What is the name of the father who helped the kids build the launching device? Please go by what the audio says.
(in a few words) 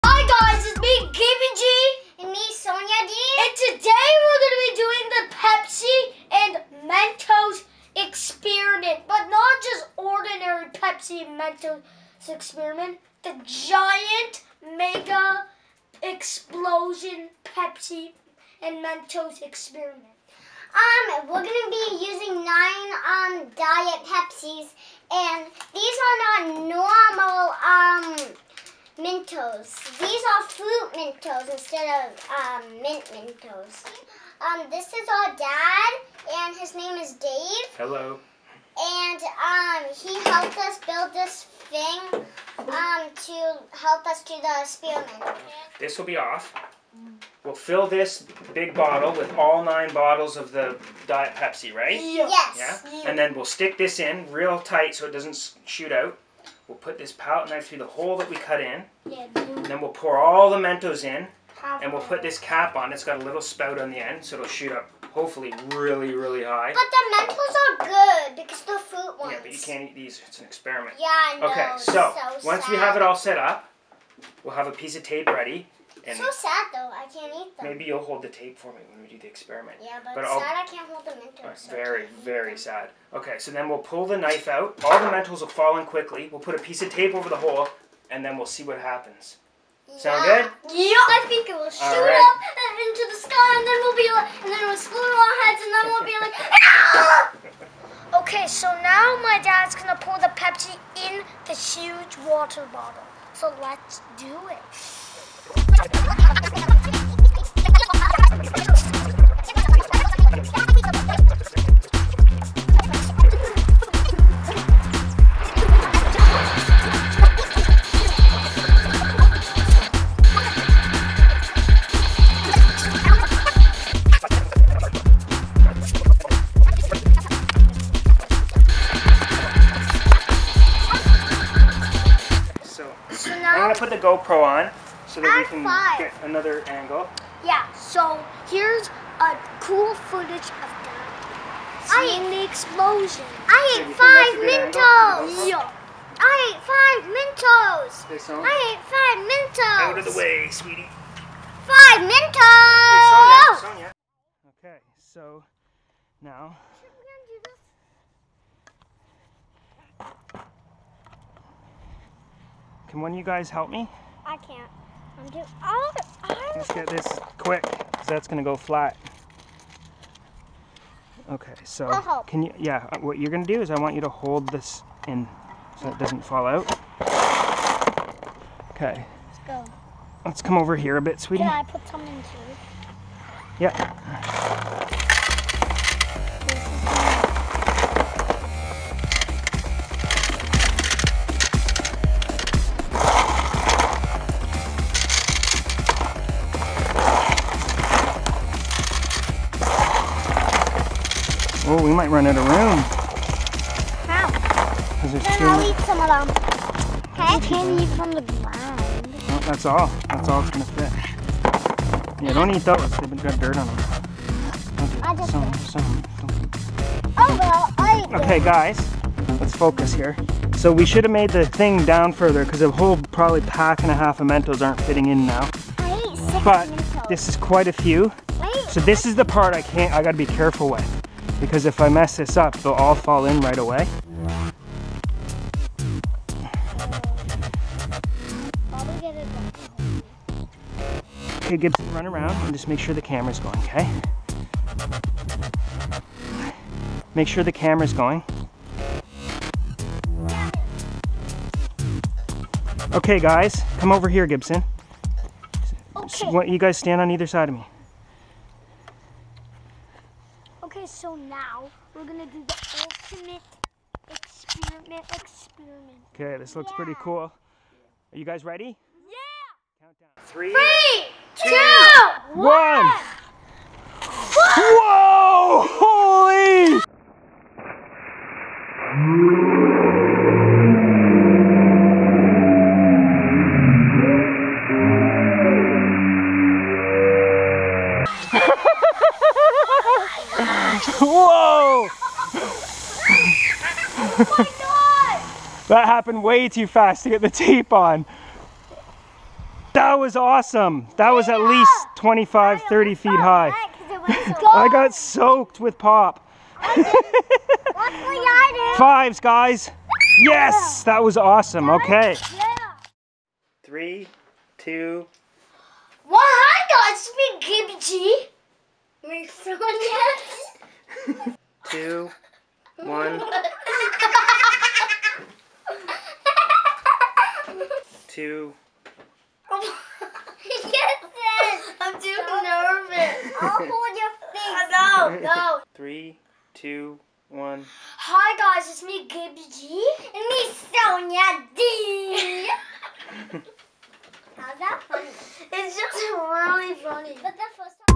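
Dave.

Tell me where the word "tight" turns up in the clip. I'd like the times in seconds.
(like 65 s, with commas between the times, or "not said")
54 s.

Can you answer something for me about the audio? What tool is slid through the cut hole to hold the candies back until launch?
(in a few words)
palette knife.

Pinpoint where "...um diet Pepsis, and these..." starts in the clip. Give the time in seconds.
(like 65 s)
23 s.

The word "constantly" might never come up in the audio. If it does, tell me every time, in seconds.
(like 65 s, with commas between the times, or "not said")
not said.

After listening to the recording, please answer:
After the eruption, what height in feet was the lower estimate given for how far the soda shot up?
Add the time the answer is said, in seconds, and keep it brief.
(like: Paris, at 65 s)
25, at 301 s.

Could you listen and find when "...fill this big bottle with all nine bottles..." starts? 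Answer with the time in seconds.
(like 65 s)
47 s.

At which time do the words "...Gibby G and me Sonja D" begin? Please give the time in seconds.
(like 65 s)
339 s.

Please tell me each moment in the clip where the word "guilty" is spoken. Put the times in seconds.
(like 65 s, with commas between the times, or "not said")
not said.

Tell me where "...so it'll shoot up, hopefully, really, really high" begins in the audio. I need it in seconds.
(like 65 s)
64 s.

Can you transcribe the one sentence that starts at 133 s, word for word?
put the GoPro on so that we can get another angle.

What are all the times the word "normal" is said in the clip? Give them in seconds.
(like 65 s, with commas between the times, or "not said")
26 s.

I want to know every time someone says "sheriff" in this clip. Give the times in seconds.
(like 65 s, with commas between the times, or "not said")
not said.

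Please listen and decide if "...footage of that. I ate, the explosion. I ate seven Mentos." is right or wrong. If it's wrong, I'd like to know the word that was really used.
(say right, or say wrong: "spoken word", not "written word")
wrong: "five", not "seven".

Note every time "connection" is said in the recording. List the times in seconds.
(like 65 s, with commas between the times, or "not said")
not said.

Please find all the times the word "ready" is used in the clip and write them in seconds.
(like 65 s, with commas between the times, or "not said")
75 s, 268 s.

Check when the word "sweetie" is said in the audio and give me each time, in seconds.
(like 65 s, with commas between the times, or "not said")
150 s, 181 s.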